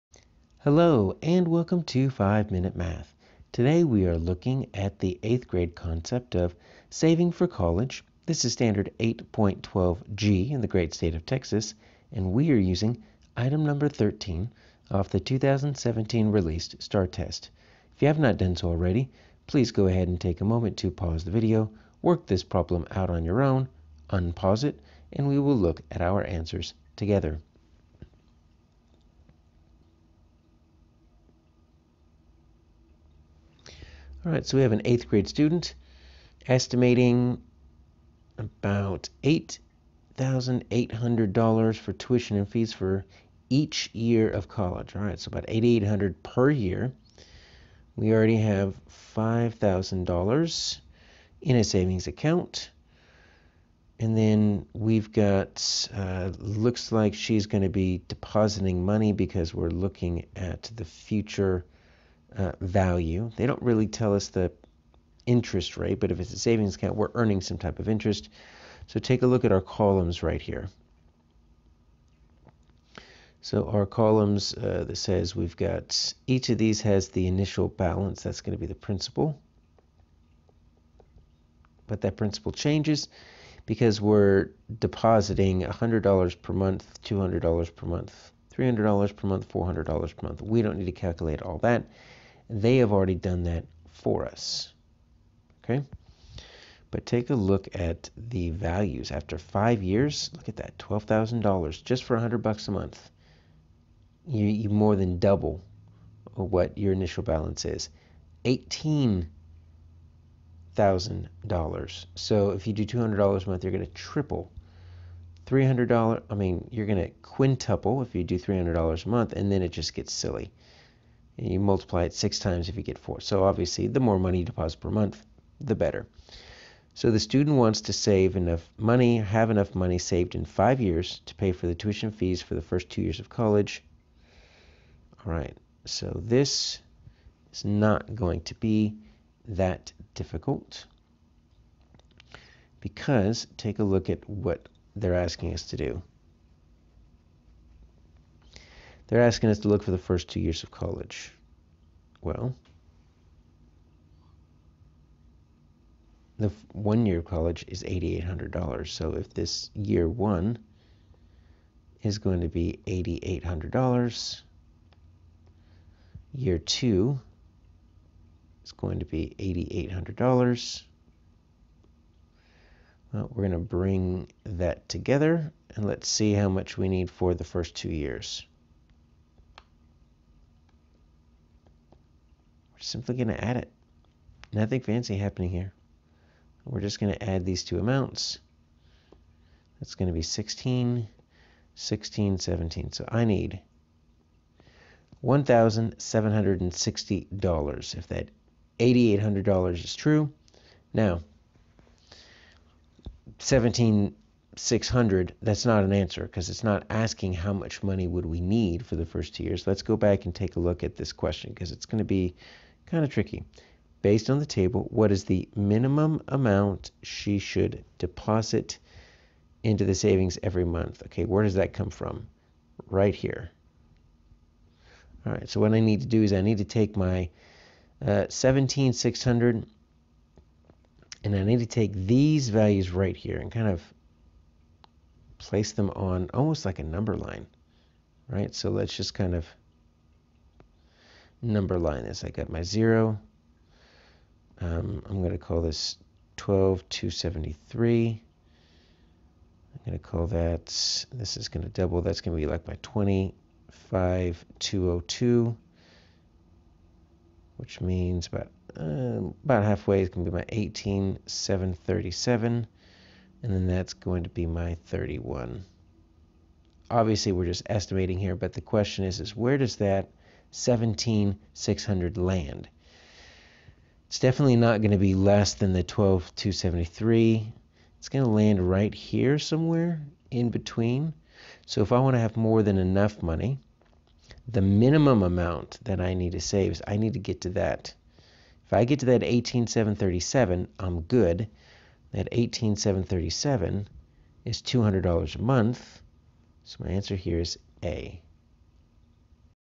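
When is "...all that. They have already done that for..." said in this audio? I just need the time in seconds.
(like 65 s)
91 s.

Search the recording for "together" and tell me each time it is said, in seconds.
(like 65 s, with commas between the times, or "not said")
26 s, 174 s.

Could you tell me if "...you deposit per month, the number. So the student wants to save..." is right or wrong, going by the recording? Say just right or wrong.
wrong.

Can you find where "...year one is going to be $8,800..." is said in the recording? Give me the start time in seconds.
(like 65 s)
159 s.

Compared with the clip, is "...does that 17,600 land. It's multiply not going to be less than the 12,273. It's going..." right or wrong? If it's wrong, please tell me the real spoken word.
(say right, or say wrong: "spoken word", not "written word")
wrong: "definitely", not "multiply".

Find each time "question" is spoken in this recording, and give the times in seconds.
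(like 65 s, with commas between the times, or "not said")
211 s, 268 s.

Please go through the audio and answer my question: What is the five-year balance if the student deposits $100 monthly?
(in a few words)
$12,000.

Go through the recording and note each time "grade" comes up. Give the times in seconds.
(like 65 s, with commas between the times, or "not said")
5 s, 35 s.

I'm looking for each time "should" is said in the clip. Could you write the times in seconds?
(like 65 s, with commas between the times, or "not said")
217 s.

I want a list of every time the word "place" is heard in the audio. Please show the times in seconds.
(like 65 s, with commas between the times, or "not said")
235 s.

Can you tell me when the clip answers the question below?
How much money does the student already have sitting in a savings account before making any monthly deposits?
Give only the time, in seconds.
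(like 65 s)
49 s.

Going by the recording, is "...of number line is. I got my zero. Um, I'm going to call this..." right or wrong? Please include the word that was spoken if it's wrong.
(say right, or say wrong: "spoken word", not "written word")
right.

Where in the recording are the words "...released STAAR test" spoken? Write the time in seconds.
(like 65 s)
16 s.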